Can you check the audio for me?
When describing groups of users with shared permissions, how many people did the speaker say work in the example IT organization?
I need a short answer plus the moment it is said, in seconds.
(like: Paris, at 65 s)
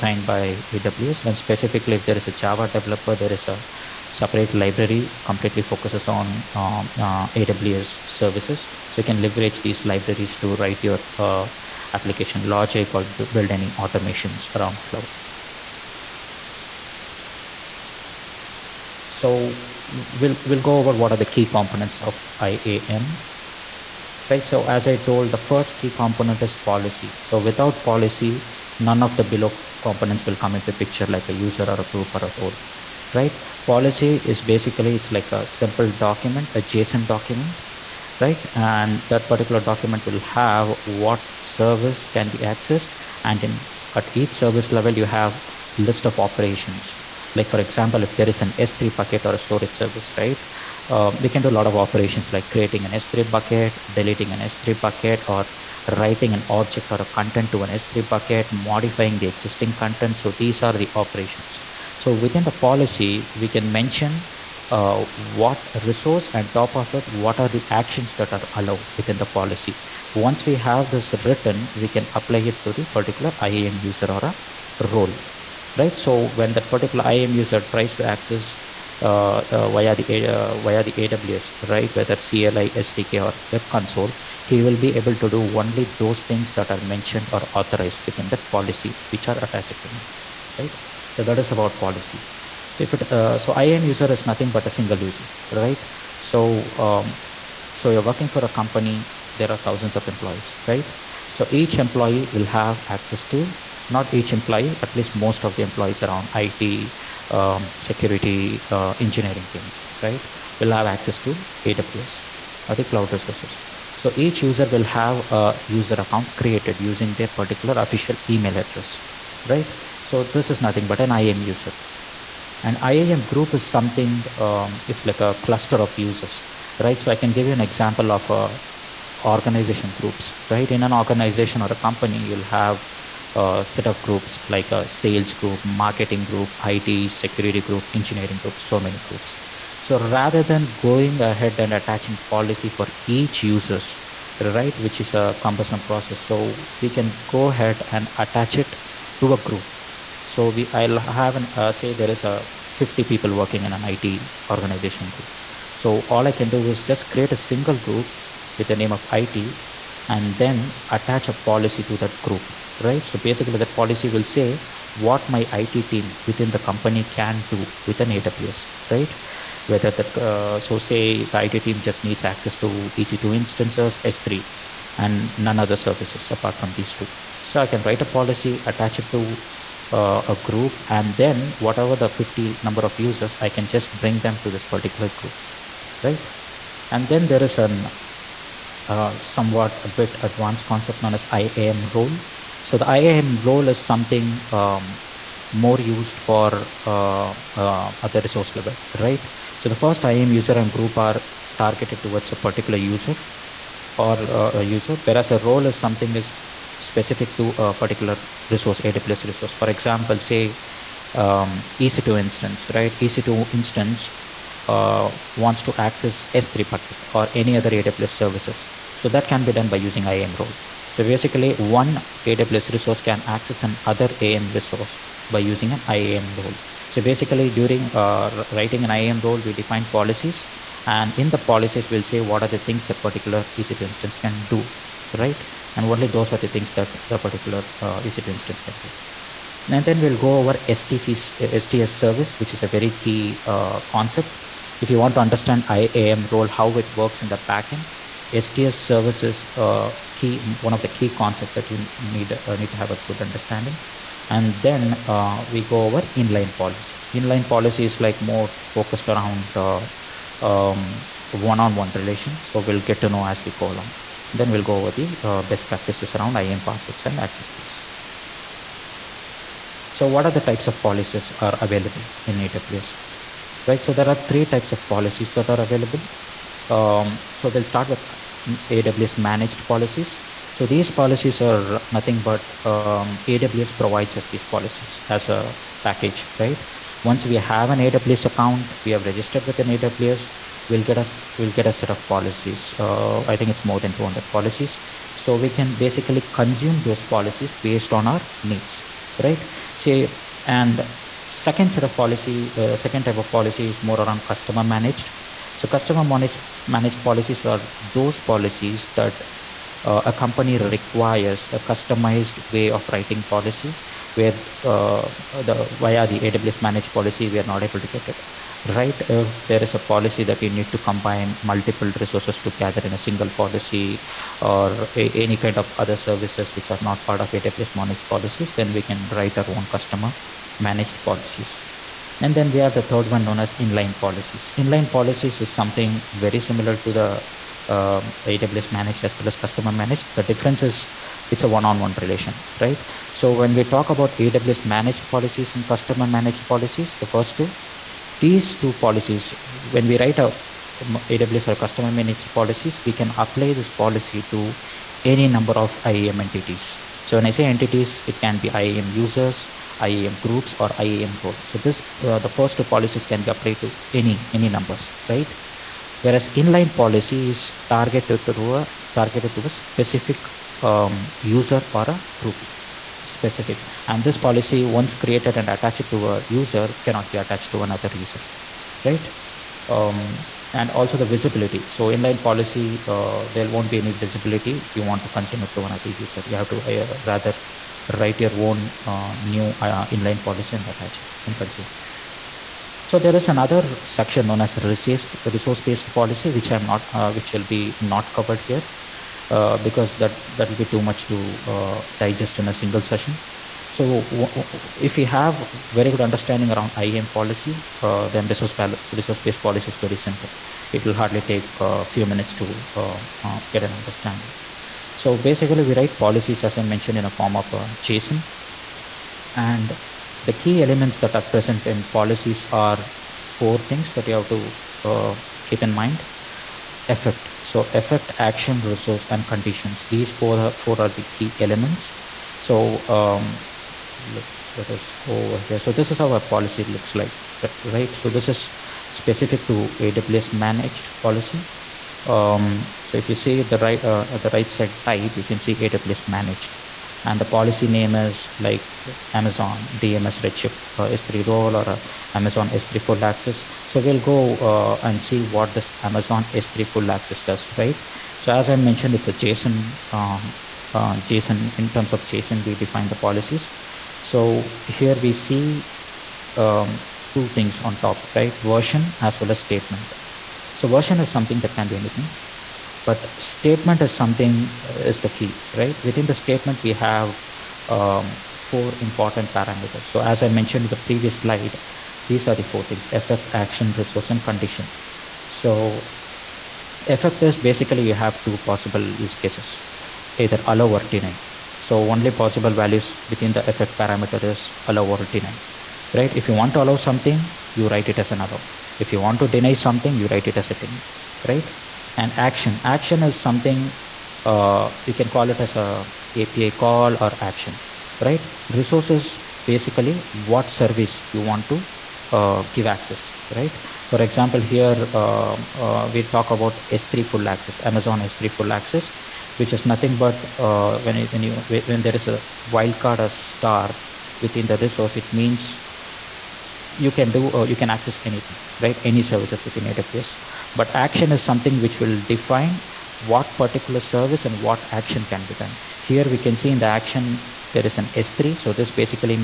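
50, at 151 s.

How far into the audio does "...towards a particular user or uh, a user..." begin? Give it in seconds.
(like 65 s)
202 s.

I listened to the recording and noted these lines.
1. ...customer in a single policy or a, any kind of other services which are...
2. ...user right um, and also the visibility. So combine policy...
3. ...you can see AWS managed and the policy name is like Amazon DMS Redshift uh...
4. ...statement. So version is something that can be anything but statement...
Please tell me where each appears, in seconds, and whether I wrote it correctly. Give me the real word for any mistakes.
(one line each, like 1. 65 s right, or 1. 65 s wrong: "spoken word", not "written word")
1. 322 s wrong: "together", not "customer"
2. 377 s wrong: "inline", not "combine"
3. 445 s right
4. 469 s right.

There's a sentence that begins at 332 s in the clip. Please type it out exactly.
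And then we have the third one known as inline policies.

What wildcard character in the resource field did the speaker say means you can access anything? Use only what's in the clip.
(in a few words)
star.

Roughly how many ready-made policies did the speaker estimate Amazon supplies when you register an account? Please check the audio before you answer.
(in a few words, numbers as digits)
more than 200.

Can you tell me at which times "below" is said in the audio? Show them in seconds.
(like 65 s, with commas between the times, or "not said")
29 s.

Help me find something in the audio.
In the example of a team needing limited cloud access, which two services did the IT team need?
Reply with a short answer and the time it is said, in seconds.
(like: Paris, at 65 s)
EC2 instances, S3, at 172 s.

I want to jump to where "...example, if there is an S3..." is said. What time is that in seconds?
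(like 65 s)
47 s.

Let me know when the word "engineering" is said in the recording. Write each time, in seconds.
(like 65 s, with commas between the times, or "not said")
108 s, 137 s.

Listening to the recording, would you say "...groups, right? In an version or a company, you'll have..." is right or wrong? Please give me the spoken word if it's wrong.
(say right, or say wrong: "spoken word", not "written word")
wrong: "organization", not "version".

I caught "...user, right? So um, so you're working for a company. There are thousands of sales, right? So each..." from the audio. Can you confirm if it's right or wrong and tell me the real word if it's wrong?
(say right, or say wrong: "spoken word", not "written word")
wrong: "employees", not "sales".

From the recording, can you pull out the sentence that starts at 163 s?
So basically that policy will say what my IT team within the company can do with an AWS, right?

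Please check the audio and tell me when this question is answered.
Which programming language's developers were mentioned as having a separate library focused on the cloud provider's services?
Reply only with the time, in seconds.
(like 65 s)
2 s.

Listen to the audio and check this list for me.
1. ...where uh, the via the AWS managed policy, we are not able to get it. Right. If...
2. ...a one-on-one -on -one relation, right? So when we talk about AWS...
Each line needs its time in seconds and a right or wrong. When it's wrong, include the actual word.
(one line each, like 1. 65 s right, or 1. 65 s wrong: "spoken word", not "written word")
1. 314 s right
2. 341 s right.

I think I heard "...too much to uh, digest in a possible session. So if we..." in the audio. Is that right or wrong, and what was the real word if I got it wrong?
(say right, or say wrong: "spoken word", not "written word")
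wrong: "single", not "possible".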